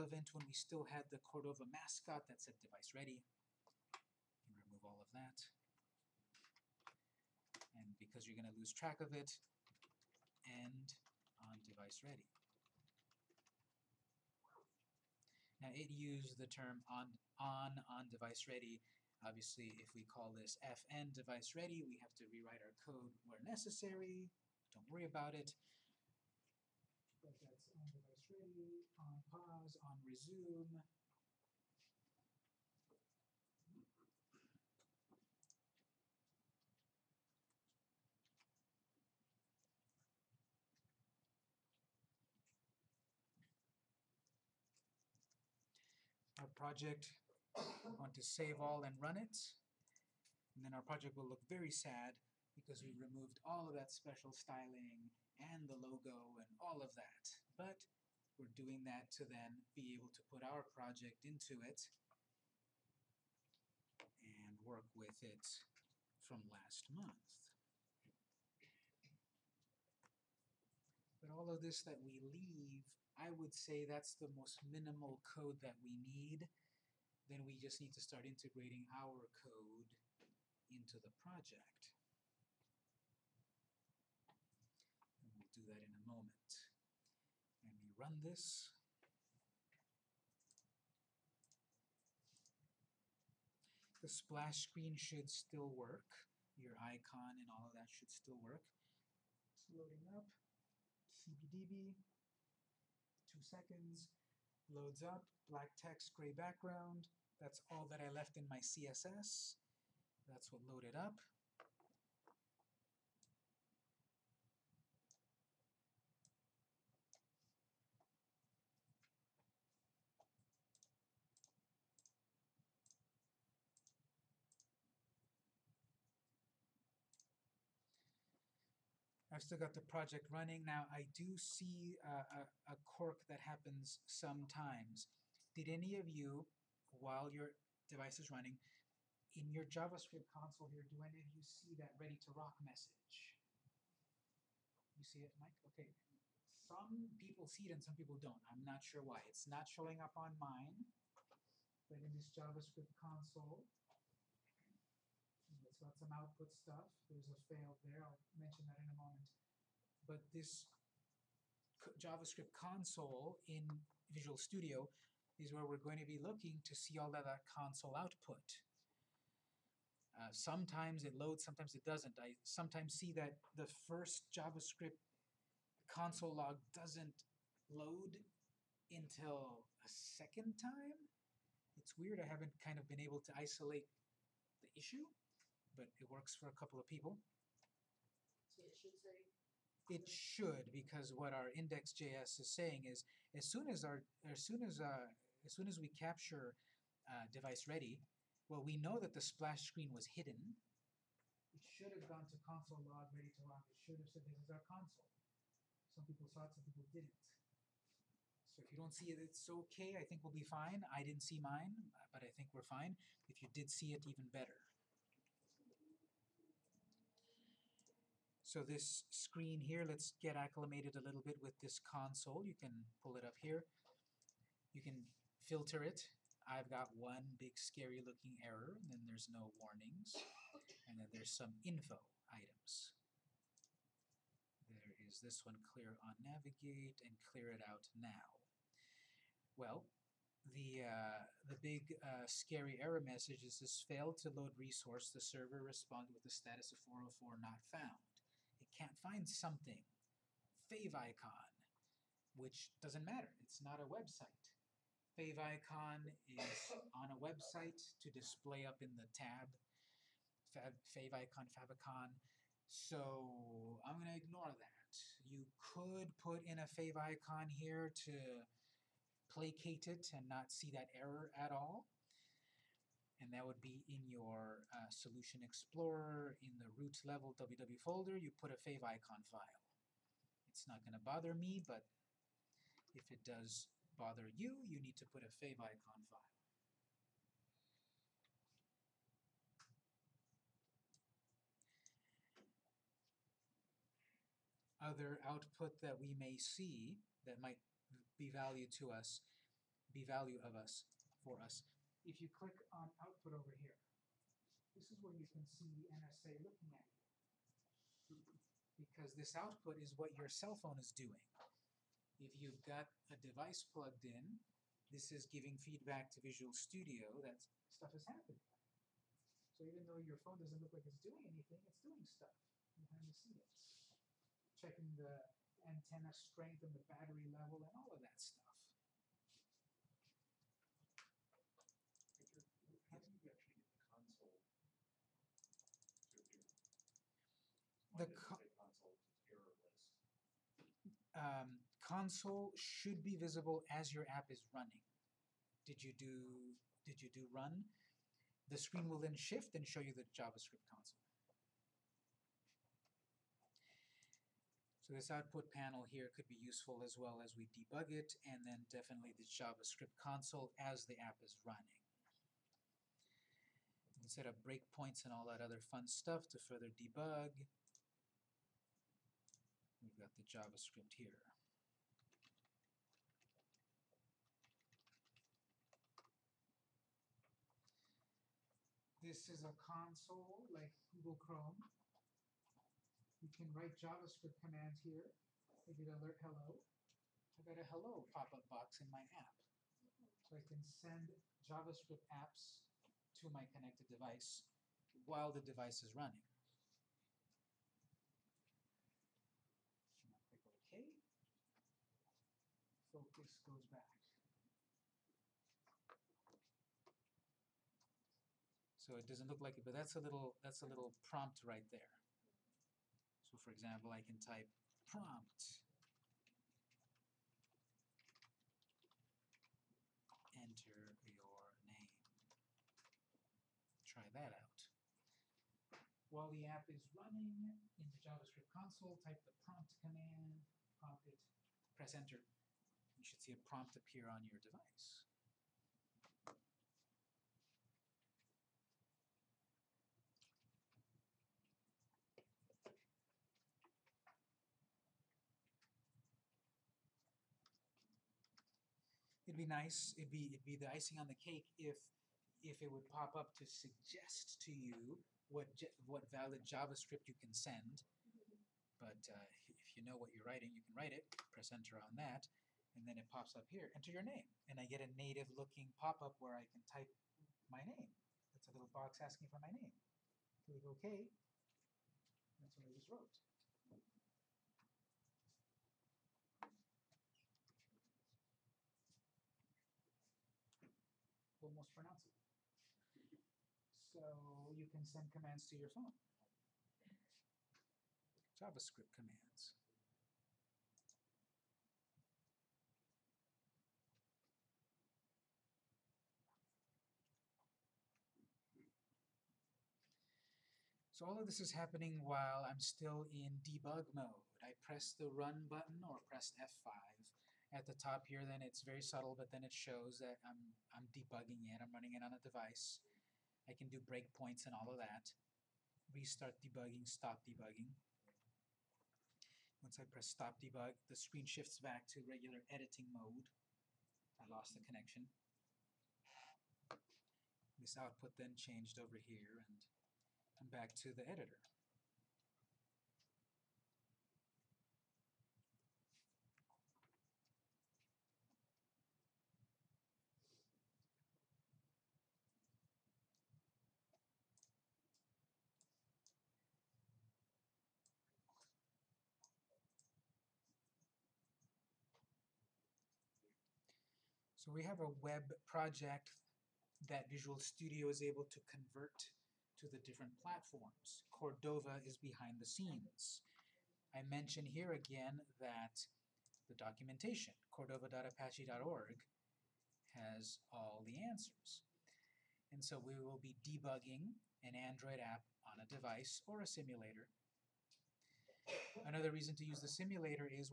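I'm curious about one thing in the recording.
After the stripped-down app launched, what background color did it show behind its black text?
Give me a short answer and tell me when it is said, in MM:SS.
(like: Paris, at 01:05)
gray, at 01:46.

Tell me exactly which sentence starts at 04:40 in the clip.
It's not going to bother me, but if it does bother you, you need to put a fav icon file.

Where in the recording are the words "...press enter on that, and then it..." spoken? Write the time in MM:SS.
07:41.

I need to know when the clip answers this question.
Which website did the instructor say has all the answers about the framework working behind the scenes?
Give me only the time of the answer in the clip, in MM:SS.
09:27.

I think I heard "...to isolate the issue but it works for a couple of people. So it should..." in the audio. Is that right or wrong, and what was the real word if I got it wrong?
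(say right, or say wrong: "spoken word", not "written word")
right.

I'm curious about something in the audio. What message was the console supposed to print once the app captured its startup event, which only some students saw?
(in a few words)
ready to rock.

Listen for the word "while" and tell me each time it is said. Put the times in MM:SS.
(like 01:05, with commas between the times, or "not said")
02:16, 06:35, 07:06, 08:22.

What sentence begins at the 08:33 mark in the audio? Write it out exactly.
I can do breakpoints and all of that.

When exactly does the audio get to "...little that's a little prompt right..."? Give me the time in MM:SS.
06:50.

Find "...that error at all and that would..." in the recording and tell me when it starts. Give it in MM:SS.
04:30.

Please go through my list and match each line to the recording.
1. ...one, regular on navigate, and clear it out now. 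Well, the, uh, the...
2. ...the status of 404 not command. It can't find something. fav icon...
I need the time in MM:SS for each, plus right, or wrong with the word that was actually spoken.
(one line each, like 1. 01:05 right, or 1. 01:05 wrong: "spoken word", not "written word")
1. 03:55 wrong: "clear", not "regular"
2. 04:06 wrong: "found", not "command".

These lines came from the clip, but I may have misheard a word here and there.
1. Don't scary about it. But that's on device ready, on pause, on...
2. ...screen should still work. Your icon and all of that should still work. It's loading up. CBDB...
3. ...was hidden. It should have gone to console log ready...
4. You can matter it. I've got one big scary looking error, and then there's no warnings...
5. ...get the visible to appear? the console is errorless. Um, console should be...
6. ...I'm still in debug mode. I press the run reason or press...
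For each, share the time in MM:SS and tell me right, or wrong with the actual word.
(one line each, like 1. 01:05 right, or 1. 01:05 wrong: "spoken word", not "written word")
1. 00:24 wrong: "worry", not "scary"
2. 01:34 right
3. 03:19 right
4. 03:44 wrong: "filter", not "matter"
5. 05:33 wrong: "console", not "visible"
6. 08:22 wrong: "button", not "reason".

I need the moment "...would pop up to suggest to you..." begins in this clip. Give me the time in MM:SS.
07:32.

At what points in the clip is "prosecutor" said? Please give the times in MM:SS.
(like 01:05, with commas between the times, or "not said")
not said.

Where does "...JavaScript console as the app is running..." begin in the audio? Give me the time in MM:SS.
05:59.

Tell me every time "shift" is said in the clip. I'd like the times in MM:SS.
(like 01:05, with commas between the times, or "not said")
05:49, 08:41.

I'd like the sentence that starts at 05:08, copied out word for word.
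Because this output is what your cell phone is doing.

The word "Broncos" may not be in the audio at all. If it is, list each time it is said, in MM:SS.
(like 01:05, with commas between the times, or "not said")
not said.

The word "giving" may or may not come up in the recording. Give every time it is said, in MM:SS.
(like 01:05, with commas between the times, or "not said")
05:15.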